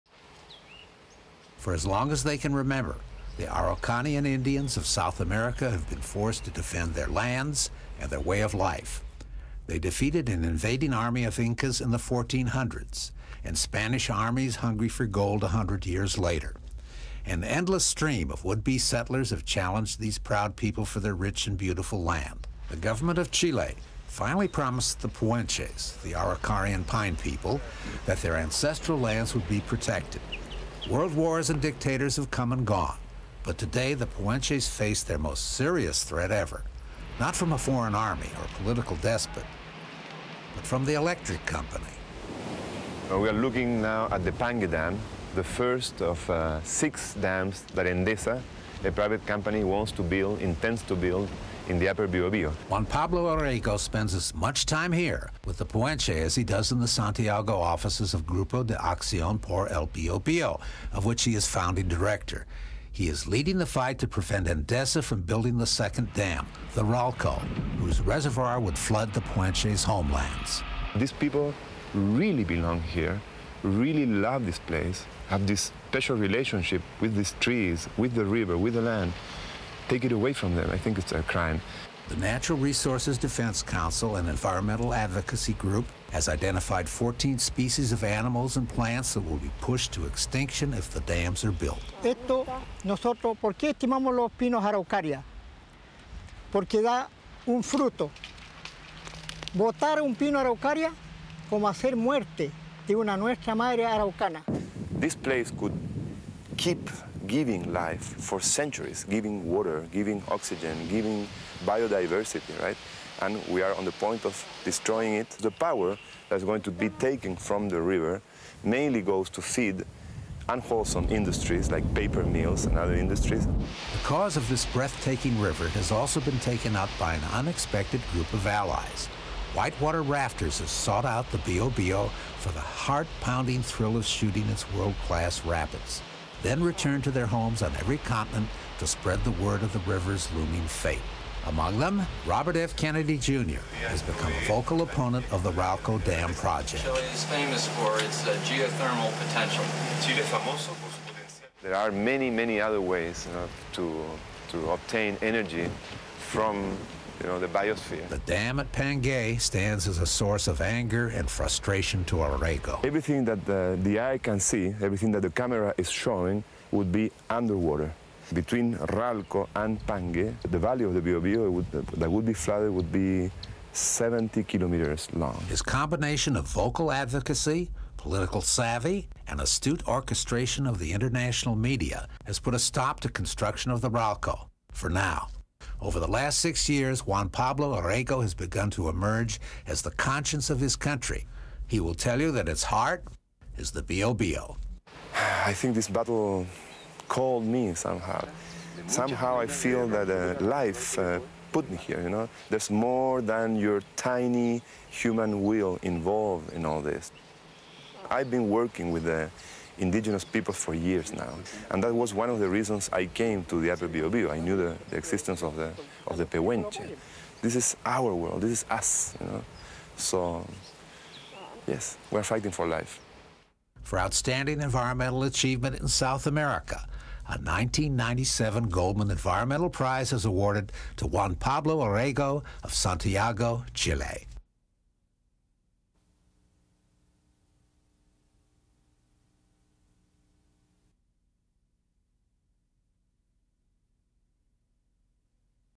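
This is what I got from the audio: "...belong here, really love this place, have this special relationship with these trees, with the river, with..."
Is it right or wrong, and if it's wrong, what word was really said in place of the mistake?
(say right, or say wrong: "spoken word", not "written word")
right.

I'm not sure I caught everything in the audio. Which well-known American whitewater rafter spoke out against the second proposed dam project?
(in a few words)
Robert F. Kennedy Jr.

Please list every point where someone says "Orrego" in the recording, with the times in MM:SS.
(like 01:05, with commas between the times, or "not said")
00:53, 02:42, 03:07, 03:51.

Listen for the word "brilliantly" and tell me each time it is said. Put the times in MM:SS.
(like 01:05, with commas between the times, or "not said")
not said.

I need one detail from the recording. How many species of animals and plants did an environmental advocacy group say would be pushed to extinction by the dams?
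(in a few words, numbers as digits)
14.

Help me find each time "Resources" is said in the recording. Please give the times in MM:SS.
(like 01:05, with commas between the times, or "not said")
01:22.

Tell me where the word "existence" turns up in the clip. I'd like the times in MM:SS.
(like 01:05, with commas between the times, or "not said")
03:34.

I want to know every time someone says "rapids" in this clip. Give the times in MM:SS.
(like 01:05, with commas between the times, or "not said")
02:15.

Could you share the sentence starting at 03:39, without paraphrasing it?
So, yes, we're fighting for life.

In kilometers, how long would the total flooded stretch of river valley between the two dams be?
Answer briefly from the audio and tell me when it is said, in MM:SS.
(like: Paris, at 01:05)
70 kilometers, at 02:53.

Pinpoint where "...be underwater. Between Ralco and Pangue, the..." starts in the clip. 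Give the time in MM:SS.
02:46.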